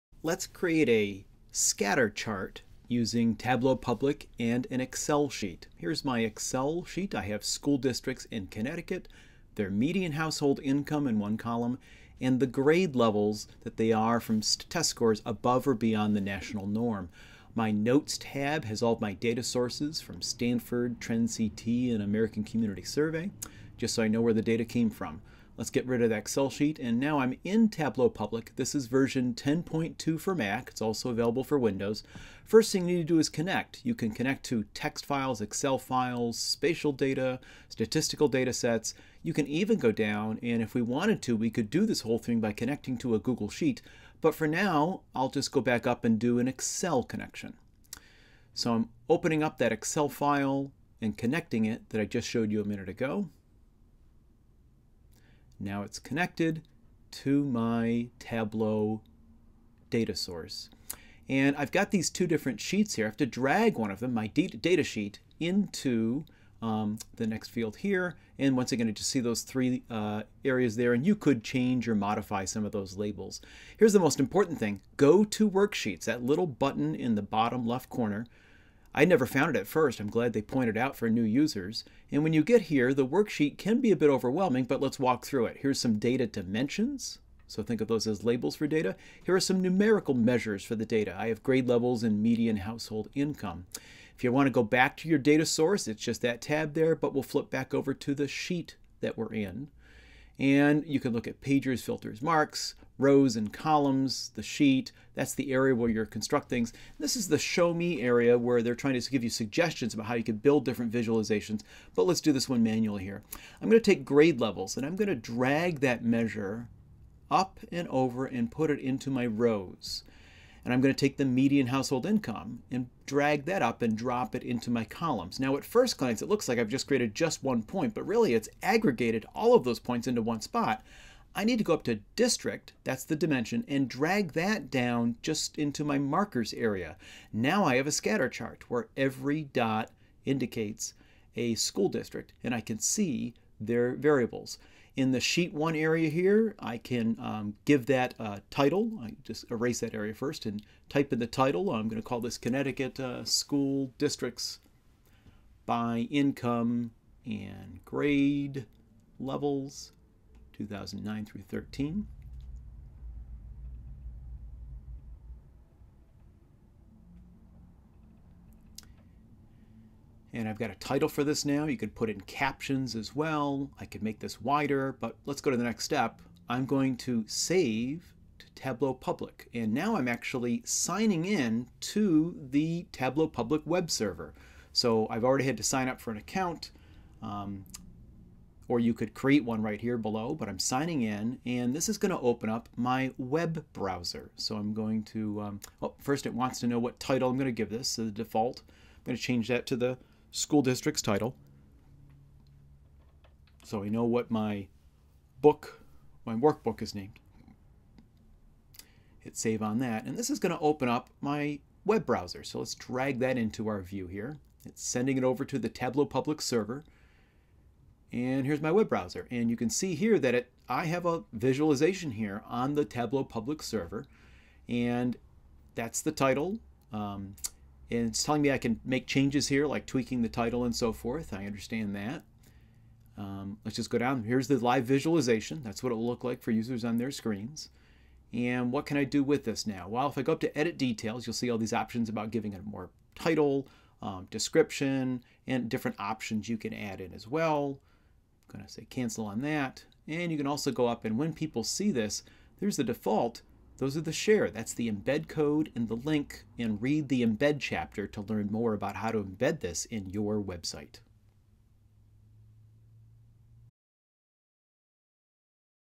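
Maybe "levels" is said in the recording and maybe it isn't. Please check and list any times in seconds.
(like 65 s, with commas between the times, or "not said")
12 s, 91 s, 114 s, 159 s.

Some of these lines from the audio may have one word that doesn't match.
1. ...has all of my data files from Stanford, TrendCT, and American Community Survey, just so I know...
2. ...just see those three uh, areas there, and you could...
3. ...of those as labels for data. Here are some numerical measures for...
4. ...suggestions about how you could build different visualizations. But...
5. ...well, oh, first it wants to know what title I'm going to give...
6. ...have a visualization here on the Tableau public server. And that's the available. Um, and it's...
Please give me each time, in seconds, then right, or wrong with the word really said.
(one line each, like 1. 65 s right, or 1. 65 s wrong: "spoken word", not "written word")
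1. 18 s wrong: "sources", not "files"
2. 68 s right
3. 87 s right
4. 109 s right
5. 195 s right
6. 220 s wrong: "title", not "available".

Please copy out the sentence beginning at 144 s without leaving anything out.
In the sheet one area here, I can um, give that a uh, title.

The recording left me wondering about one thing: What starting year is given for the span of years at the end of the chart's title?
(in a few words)
2009.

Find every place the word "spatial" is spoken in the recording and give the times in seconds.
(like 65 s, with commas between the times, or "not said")
36 s.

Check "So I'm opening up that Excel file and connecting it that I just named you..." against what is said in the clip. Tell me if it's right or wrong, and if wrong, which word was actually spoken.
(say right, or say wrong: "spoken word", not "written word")
wrong: "showed", not "named".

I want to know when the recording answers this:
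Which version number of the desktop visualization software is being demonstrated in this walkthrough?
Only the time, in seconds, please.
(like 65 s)
29 s.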